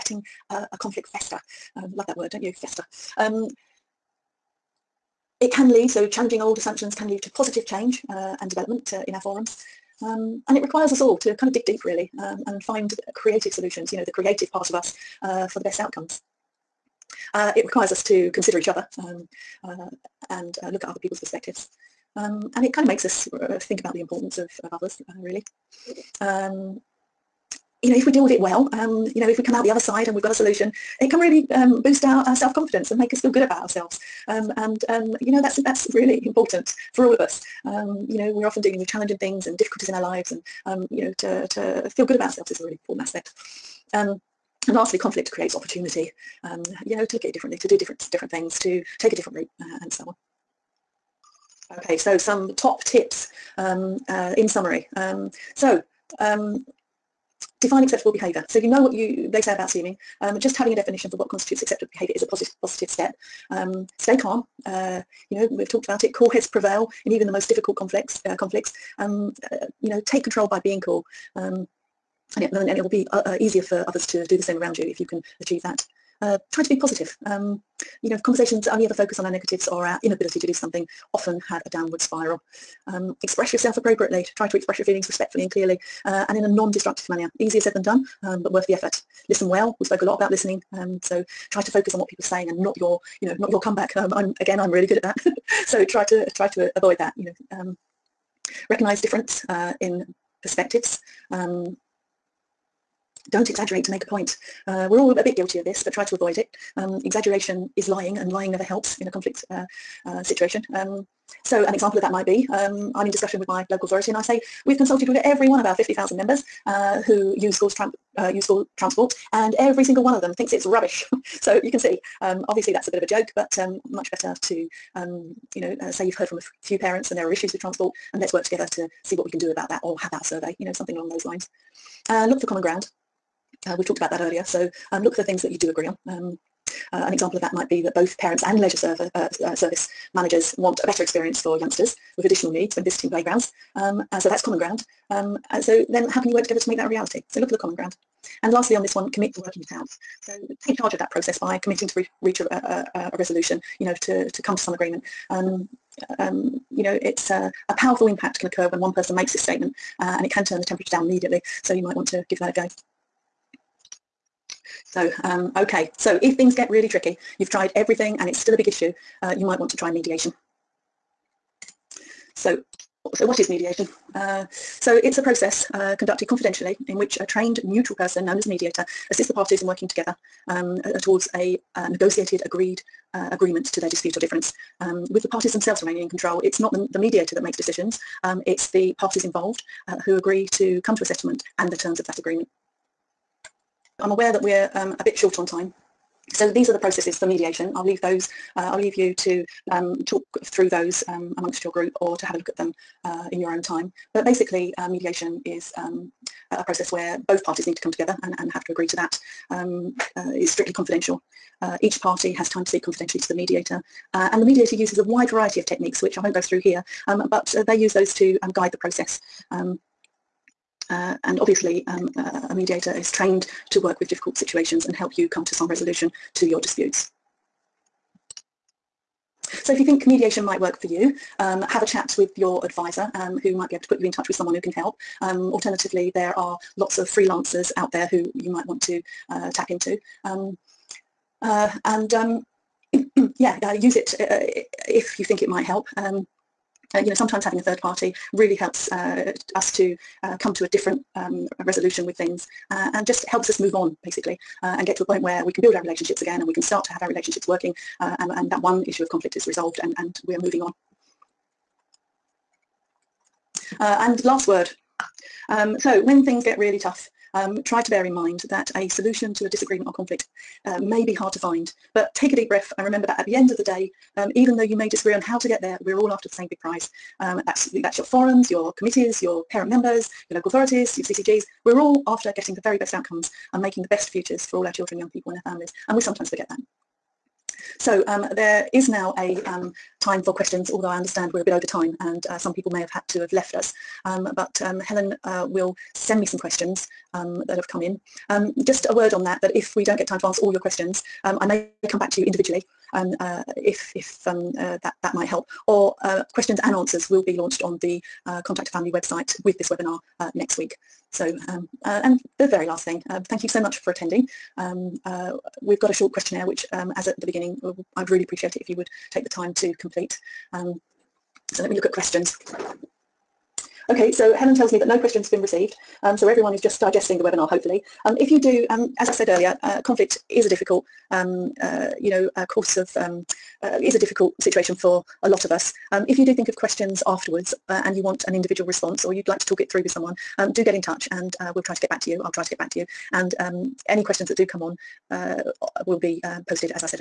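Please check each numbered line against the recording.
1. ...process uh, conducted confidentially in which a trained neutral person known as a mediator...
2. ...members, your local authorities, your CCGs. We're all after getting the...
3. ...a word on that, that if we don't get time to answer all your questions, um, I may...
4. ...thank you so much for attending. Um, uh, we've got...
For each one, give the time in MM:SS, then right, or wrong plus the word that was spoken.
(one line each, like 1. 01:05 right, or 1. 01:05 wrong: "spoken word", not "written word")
1. 02:55 right
2. 04:39 right
3. 04:58 right
4. 05:13 right.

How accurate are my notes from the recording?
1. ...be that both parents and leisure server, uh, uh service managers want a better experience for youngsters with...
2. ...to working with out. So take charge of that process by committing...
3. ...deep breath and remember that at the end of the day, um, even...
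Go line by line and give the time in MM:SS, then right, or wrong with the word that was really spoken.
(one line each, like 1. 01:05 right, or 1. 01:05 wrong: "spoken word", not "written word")
1. 02:17 right
2. 02:29 right
3. 04:32 right.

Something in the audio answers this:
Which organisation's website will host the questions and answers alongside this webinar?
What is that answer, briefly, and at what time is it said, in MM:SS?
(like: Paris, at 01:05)
Contact a Family, at 05:08.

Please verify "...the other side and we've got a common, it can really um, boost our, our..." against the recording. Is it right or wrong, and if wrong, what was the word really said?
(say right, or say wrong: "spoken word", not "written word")
wrong: "solution", not "common".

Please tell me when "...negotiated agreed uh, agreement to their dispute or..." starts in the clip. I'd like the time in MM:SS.
03:01.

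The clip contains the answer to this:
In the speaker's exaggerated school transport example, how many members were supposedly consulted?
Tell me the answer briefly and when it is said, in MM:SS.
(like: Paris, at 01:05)
50,000, at 01:55.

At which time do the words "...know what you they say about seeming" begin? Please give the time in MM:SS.
00:58.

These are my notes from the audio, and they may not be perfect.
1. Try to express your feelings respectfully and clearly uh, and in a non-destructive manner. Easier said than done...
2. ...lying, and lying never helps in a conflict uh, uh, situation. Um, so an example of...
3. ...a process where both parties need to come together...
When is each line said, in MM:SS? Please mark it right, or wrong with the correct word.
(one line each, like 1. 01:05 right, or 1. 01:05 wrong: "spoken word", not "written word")
1. 01:24 right
2. 01:47 right
3. 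03:26 right.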